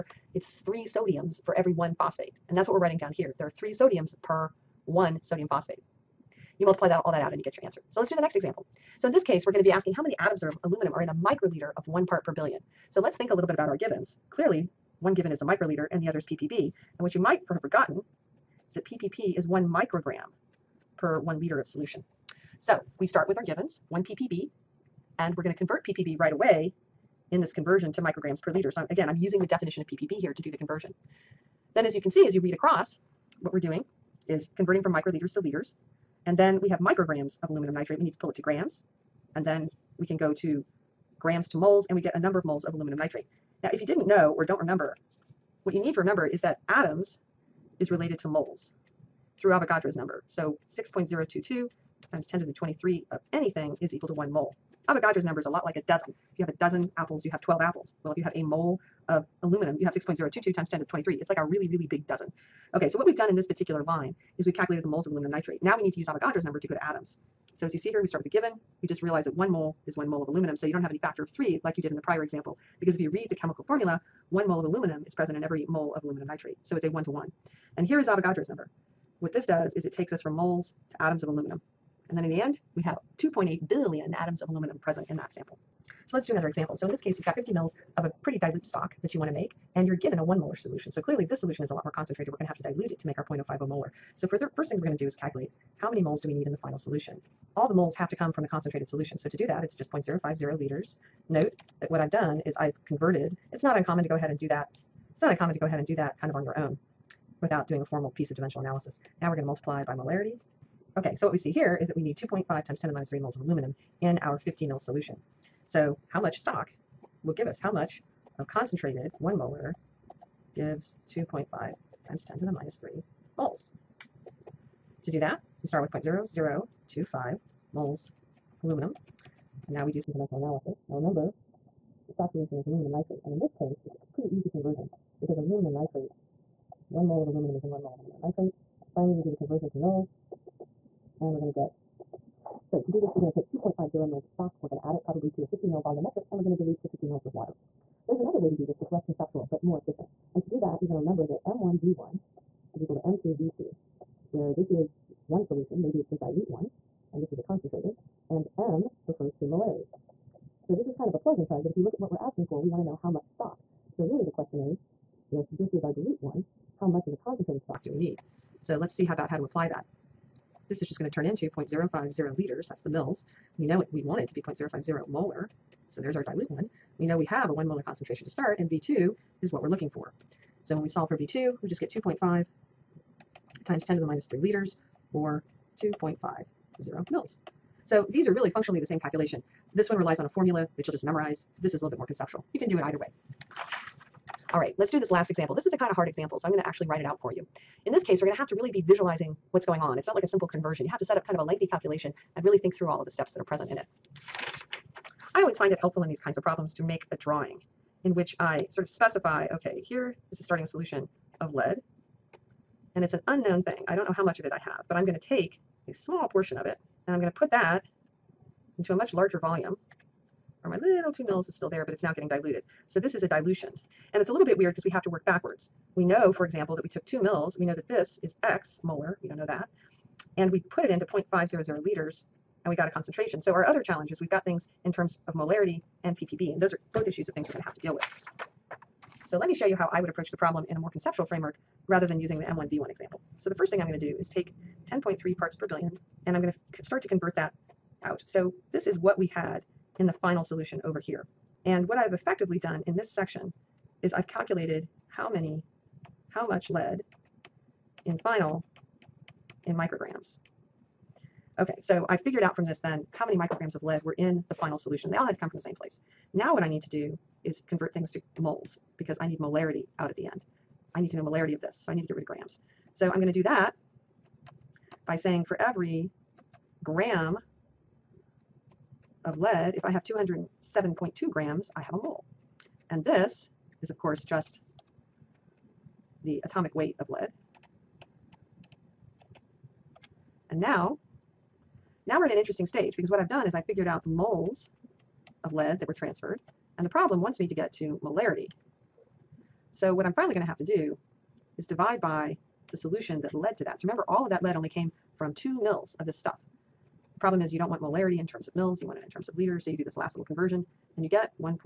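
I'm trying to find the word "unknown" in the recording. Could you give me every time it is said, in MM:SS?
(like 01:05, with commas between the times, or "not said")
03:33.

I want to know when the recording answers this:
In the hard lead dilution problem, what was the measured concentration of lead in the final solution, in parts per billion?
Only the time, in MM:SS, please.
04:04.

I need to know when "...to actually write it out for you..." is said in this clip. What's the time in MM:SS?
03:16.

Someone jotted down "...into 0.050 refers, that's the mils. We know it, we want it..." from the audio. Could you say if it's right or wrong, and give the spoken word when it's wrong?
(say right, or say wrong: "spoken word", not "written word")
wrong: "liters", not "refers".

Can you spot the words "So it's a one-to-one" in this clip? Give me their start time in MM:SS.
01:16.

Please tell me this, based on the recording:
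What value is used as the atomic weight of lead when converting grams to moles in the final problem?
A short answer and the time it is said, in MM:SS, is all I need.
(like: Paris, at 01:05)
207.2 grams, at 04:40.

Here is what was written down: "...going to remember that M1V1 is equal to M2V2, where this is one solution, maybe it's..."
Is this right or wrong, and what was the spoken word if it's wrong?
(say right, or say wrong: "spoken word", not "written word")
right.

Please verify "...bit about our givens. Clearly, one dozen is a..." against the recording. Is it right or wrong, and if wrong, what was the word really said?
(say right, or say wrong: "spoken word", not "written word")
wrong: "given", not "dozen".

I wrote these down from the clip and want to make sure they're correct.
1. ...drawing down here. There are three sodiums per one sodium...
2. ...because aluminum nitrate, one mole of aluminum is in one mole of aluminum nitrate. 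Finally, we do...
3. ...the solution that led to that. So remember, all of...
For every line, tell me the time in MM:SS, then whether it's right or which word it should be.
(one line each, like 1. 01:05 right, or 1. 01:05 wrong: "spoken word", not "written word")
1. 00:02 wrong: "writing", not "drawing"
2. 02:15 right
3. 05:02 right.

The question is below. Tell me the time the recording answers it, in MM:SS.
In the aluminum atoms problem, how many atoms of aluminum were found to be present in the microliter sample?
01:23.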